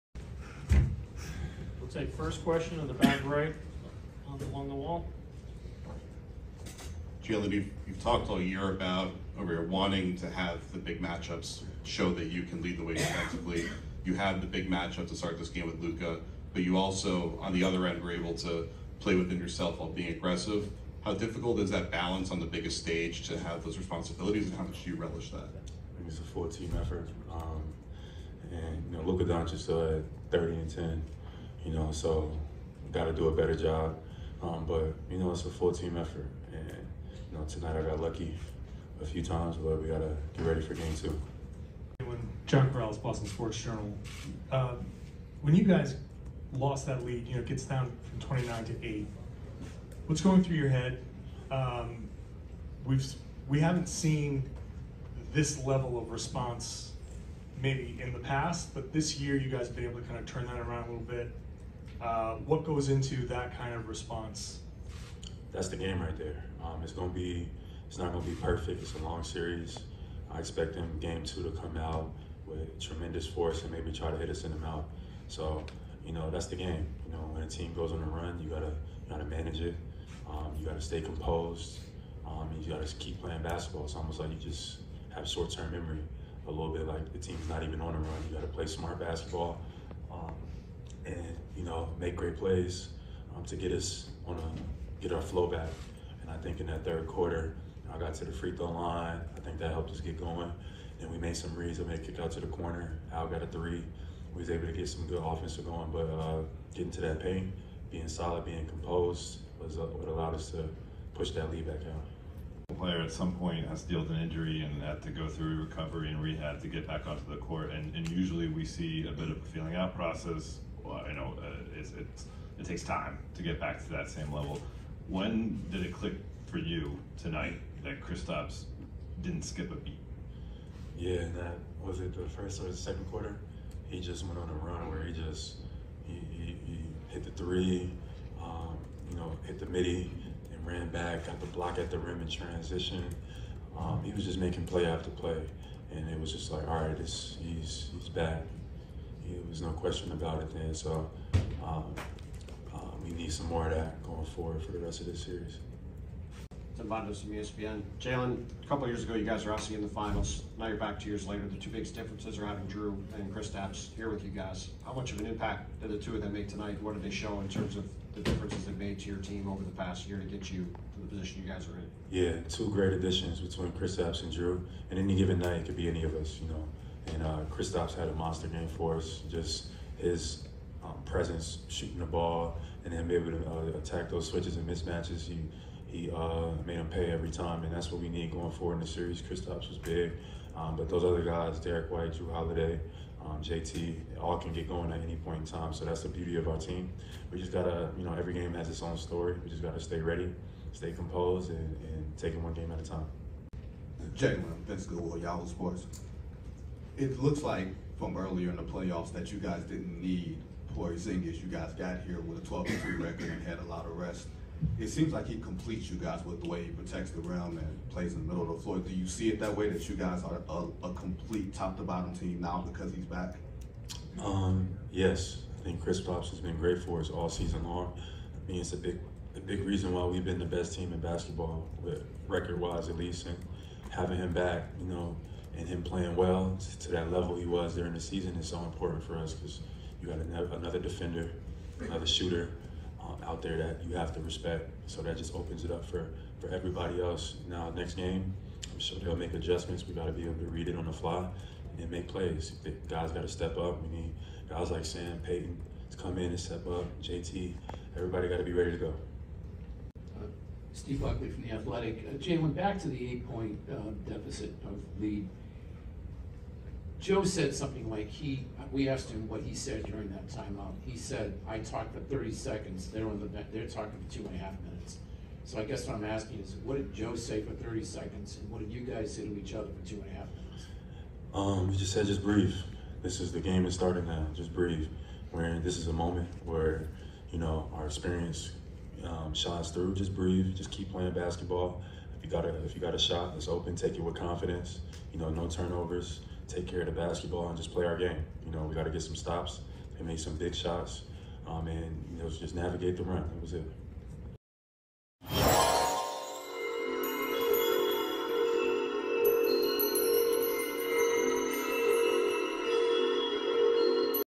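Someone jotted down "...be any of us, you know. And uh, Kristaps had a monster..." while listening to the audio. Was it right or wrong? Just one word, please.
right.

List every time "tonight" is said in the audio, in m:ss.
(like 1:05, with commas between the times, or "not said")
0:37, 2:07, 2:46.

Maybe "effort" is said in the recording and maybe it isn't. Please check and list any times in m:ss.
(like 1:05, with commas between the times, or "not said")
0:26, 0:35.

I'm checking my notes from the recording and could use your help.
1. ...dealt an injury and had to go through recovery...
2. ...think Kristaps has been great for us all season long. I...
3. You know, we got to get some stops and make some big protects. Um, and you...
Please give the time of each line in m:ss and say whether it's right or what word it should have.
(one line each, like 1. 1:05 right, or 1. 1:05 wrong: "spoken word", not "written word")
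1. 1:53 right
2. 3:45 right
3. 4:58 wrong: "shots", not "protects".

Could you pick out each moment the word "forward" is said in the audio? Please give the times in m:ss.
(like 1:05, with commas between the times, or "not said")
2:34, 3:08.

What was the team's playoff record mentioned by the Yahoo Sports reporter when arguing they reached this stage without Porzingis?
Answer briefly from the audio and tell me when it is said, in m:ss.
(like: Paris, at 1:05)
12-3, at 3:32.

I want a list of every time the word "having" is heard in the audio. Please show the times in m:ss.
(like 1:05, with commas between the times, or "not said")
2:42, 3:53.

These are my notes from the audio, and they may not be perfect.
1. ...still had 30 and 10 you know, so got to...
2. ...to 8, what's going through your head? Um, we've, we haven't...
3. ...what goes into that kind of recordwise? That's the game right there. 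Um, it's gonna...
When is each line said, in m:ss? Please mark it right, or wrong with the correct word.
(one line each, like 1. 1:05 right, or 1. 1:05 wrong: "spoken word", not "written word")
1. 0:29 right
2. 0:48 right
3. 1:02 wrong: "response", not "recordwise".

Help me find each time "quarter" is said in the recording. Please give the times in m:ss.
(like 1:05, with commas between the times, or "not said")
1:37, 2:13.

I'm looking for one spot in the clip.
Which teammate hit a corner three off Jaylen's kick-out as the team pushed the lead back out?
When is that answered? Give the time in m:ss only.
1:43.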